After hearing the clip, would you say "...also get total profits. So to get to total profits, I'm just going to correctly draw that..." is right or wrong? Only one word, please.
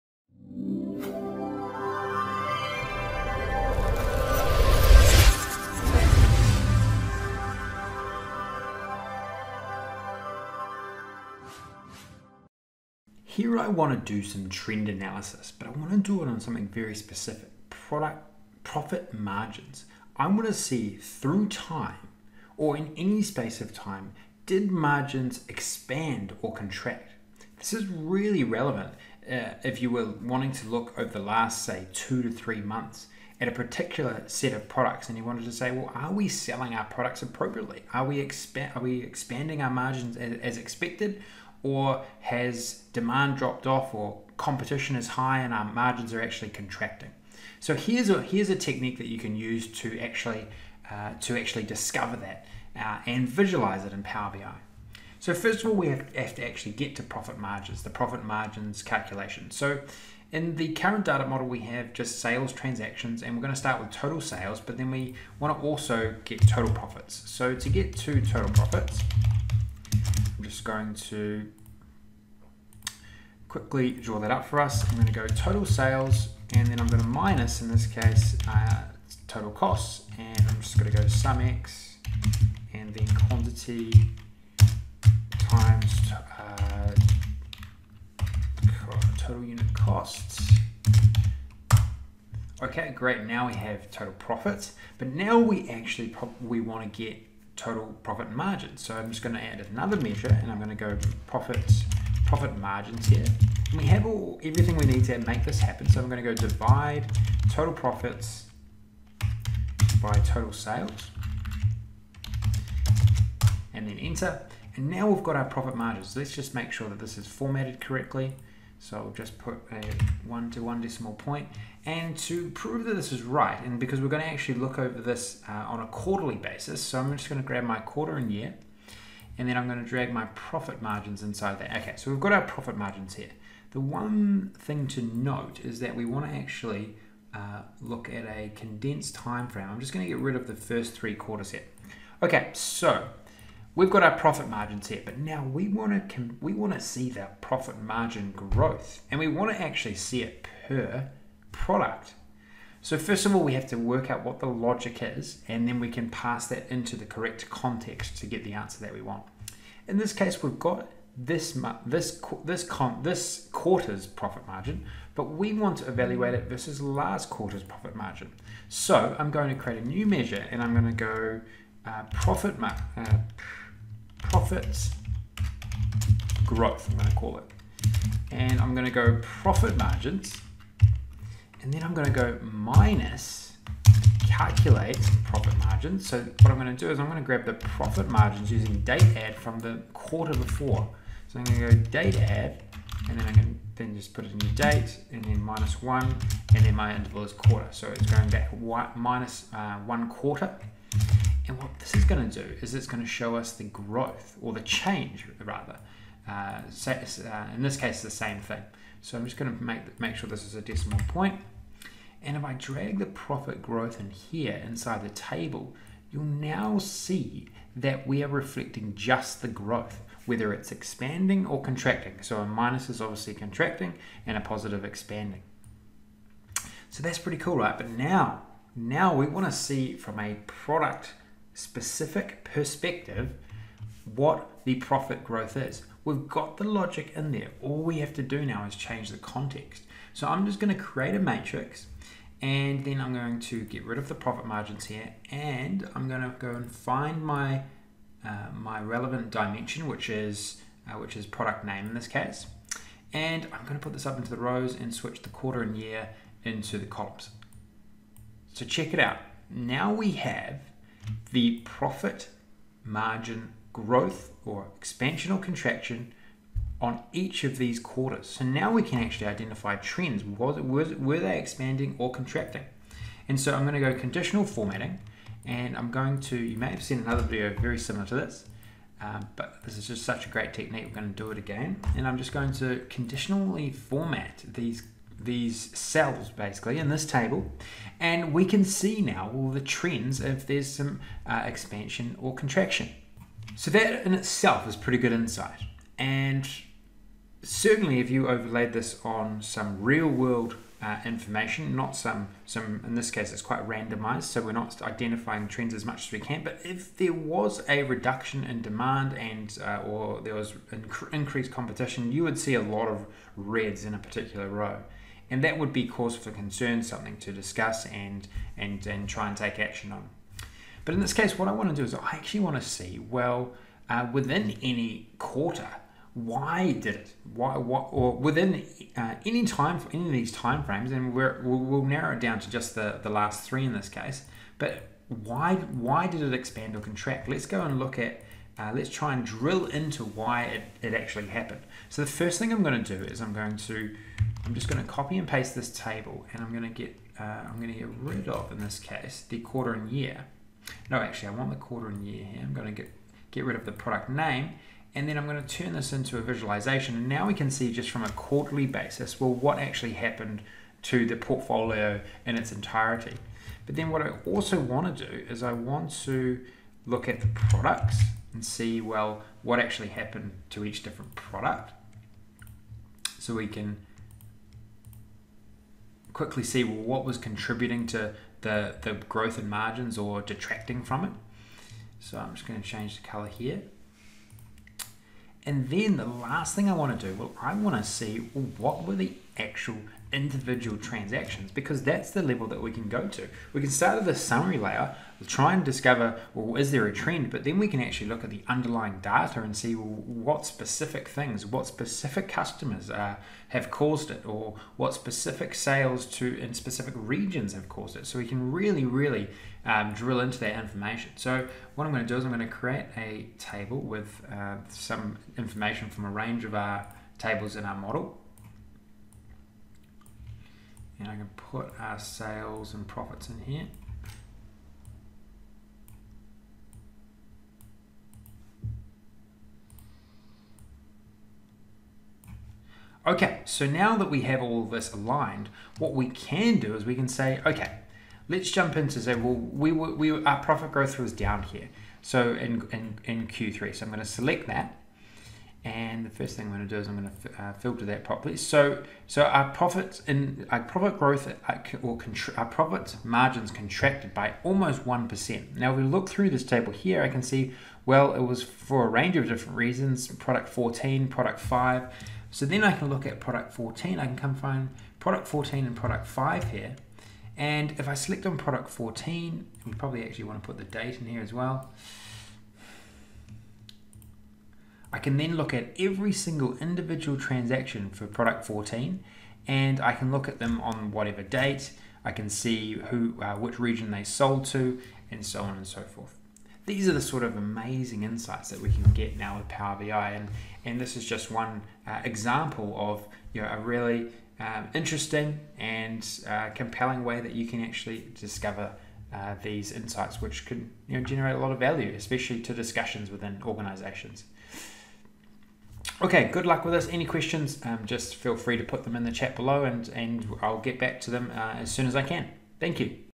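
wrong.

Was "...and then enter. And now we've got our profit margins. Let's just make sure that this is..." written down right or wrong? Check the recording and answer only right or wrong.
right.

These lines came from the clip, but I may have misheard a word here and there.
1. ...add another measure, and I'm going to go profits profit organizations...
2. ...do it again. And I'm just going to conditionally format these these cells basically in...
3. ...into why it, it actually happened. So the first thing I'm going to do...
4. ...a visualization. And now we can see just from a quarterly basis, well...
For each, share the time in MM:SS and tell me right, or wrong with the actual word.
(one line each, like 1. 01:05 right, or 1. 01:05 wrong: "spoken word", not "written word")
1. 01:39 wrong: "margins", not "organizations"
2. 04:41 right
3. 05:39 right
4. 05:56 right.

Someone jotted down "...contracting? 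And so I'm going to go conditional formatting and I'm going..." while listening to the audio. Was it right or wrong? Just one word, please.
right.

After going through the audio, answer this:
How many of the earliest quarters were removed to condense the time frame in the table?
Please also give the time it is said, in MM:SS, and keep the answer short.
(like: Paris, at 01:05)
3, at 02:20.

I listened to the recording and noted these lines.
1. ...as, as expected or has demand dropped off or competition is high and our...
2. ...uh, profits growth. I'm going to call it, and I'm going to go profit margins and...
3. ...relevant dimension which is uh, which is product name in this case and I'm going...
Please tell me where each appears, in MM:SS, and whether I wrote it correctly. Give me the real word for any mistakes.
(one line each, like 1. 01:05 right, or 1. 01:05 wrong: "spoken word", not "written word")
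1. 00:40 right
2. 02:52 right
3. 04:08 right.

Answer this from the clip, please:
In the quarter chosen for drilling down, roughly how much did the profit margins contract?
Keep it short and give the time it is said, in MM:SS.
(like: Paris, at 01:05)
almost 1%, at 07:34.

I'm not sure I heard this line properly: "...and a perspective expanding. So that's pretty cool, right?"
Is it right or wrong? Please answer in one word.
wrong.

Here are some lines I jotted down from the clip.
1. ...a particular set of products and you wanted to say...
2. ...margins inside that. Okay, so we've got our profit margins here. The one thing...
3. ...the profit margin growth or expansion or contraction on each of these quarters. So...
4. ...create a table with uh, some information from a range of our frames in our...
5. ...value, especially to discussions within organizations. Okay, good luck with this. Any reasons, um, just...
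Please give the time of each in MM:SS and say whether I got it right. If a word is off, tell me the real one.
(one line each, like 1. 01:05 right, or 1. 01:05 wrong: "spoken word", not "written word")
1. 00:33 right
2. 02:10 right
3. 04:21 right
4. 06:52 wrong: "tables", not "frames"
5. 08:21 wrong: "questions", not "reasons".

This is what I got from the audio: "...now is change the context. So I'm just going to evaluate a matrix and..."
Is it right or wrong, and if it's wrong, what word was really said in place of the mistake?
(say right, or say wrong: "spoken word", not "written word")
wrong: "create", not "evaluate".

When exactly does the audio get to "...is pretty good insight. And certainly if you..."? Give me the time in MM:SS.
04:54.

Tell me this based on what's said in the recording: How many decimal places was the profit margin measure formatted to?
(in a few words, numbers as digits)
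1.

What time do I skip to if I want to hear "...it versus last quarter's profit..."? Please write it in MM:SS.
02:46.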